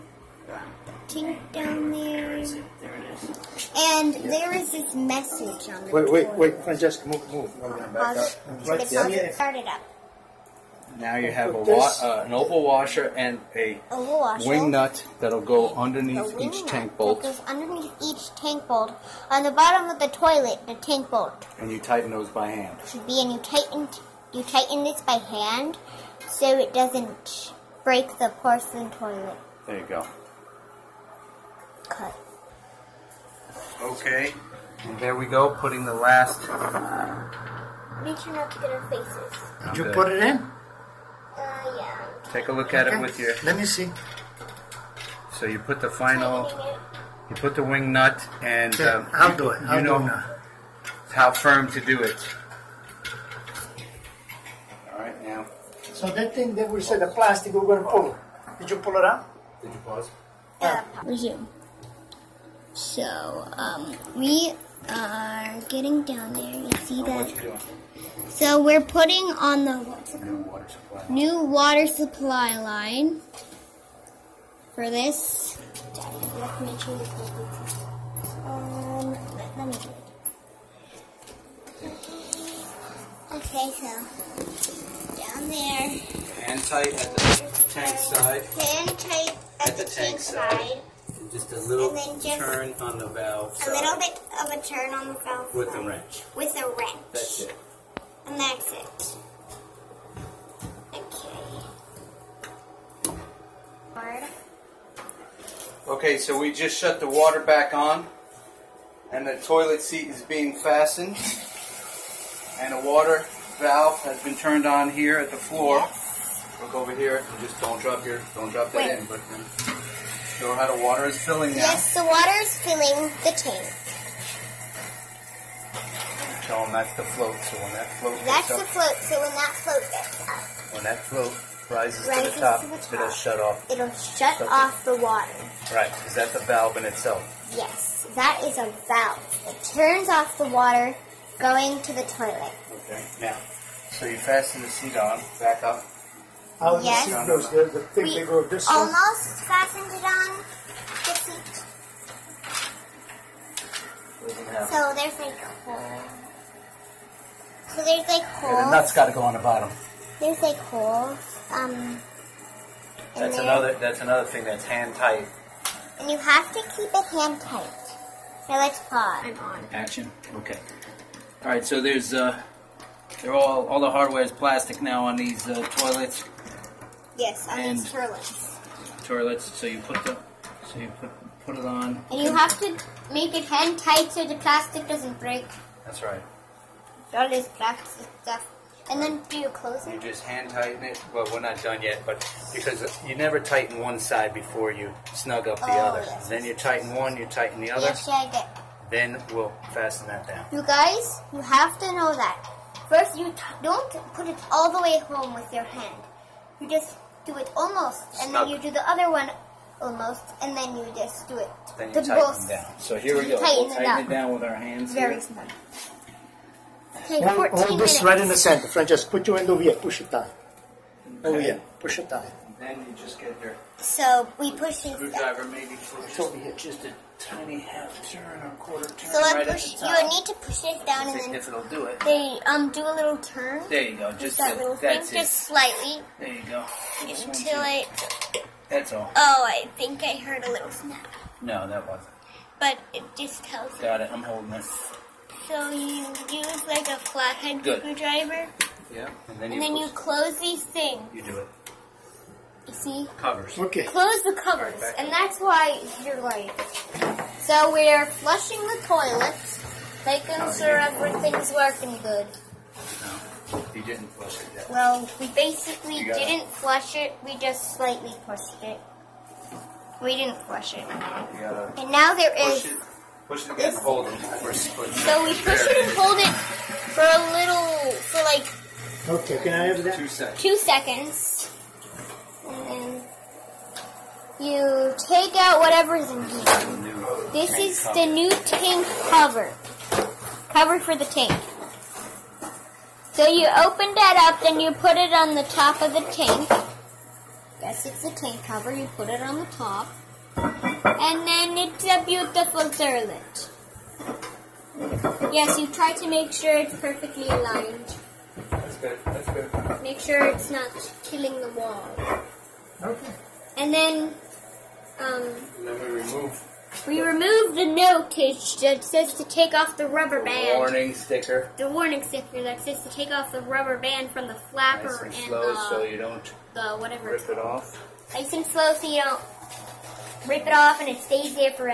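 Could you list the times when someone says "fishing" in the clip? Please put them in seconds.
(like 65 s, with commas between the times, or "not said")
not said.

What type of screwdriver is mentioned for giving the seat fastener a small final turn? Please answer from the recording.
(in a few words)
flathead.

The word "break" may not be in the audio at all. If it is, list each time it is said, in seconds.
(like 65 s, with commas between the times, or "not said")
27 s, 185 s.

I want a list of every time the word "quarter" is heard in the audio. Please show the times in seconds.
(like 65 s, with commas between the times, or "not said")
228 s.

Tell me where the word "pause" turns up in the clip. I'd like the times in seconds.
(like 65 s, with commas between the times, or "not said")
59 s, 168 s.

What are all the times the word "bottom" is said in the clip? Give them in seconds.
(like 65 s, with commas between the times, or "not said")
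19 s, 159 s.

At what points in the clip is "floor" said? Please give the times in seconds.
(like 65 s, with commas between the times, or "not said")
115 s.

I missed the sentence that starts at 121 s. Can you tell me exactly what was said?
Yes, the water is filling the tank.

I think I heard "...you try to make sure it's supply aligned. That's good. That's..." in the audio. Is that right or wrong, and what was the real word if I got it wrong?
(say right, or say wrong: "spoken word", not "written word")
wrong: "perfectly", not "supply".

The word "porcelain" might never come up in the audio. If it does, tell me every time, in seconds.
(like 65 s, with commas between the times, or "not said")
28 s.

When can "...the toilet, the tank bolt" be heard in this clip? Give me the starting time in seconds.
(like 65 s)
19 s.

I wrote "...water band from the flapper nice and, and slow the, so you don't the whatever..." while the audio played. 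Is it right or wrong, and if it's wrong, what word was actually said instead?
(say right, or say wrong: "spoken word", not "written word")
wrong: "rubber", not "water".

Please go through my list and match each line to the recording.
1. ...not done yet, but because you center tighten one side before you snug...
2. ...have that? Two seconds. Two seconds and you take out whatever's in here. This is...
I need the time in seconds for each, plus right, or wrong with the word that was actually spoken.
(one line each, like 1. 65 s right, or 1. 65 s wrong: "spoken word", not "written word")
1. 191 s wrong: "never", not "center"
2. 279 s right.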